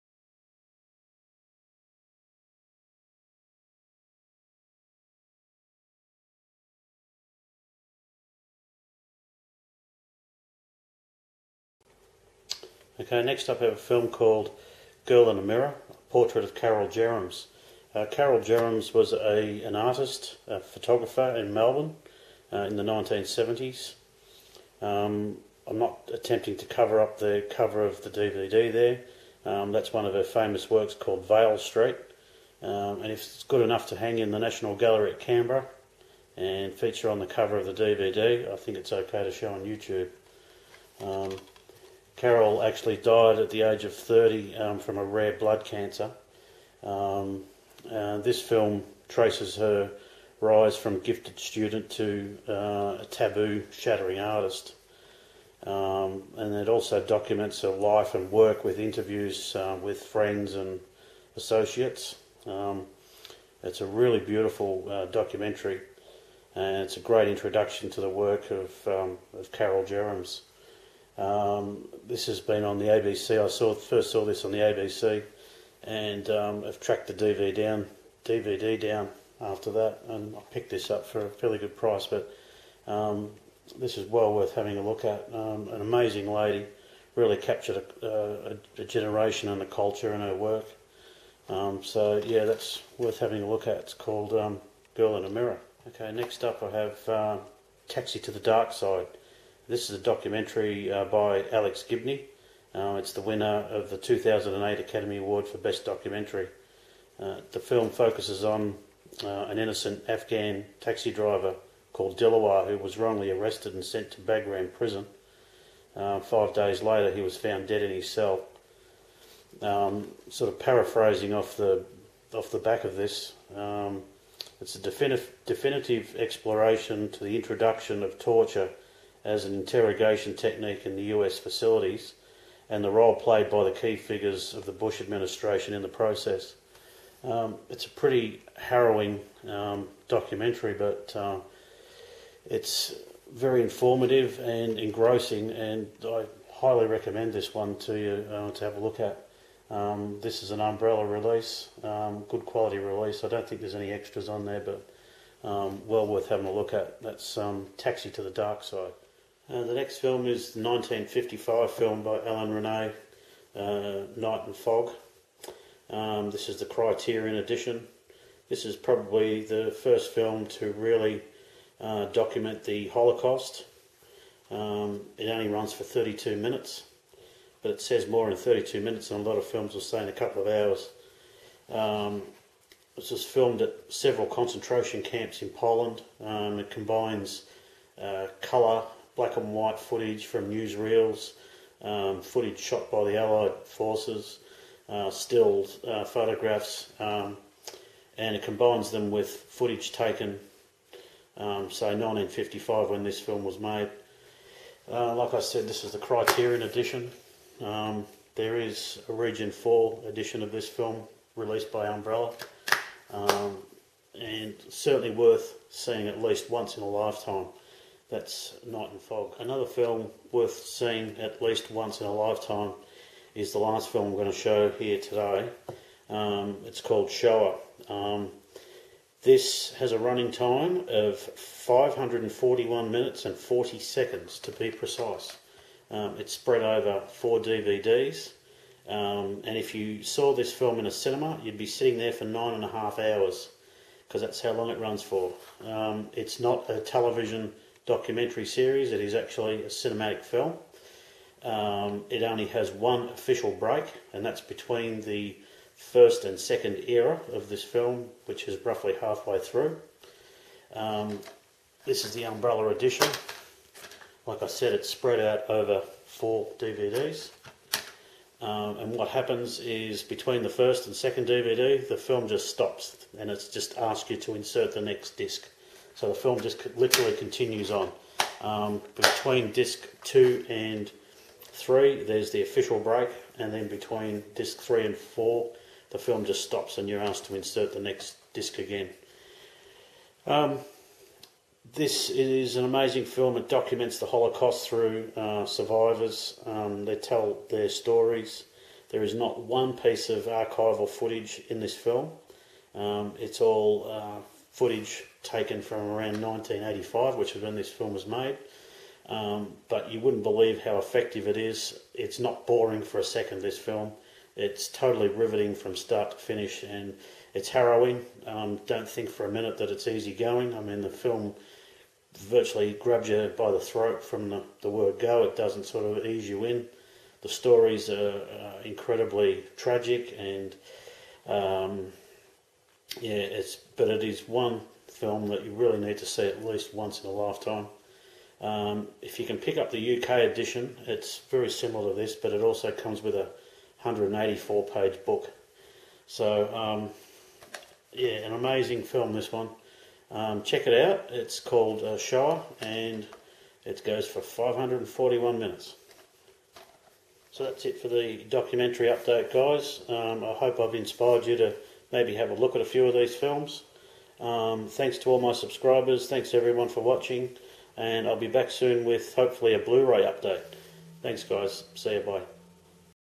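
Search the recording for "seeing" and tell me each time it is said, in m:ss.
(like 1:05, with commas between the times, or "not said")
3:35, 3:40.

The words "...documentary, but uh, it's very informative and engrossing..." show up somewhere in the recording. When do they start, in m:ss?
2:20.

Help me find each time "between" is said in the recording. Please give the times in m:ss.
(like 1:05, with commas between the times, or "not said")
4:14, 4:30, 4:38, 4:43.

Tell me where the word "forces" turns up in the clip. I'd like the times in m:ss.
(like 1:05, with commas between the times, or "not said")
3:13.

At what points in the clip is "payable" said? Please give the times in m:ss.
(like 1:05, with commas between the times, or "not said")
not said.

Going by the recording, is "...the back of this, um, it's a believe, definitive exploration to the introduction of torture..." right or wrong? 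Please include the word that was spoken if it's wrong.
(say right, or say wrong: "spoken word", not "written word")
wrong: "definitive", not "believe".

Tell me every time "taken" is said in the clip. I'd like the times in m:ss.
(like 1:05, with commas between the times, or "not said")
3:19, 5:05.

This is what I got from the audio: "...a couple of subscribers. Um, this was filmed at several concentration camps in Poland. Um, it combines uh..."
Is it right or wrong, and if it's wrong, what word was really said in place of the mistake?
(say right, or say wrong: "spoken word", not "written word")
wrong: "hours", not "subscribers".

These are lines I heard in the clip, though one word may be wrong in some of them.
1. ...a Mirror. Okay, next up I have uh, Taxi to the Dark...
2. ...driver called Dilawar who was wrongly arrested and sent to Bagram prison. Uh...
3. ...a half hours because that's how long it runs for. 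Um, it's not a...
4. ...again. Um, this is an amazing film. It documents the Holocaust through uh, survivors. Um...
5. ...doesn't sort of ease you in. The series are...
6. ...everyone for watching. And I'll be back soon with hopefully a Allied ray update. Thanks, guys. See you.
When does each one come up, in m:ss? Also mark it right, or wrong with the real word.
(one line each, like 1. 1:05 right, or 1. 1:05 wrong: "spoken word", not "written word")
1. 1:35 right
2. 1:51 right
3. 4:02 right
4. 4:48 right
5. 5:25 wrong: "stories", not "series"
6. 6:06 wrong: "Blu", not "Allied".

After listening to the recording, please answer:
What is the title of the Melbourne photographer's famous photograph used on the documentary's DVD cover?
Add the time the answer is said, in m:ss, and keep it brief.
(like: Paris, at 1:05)
Vale Street, at 0:31.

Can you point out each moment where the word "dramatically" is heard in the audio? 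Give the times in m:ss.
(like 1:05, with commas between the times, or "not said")
not said.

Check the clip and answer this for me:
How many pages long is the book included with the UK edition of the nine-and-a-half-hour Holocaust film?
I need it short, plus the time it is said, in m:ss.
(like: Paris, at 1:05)
184, at 5:43.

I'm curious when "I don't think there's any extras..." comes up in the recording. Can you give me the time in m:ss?
2:33.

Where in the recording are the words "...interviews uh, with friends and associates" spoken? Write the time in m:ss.
0:58.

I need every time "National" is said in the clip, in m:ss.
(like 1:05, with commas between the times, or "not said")
0:34.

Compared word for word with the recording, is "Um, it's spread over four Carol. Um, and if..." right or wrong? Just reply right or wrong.
wrong.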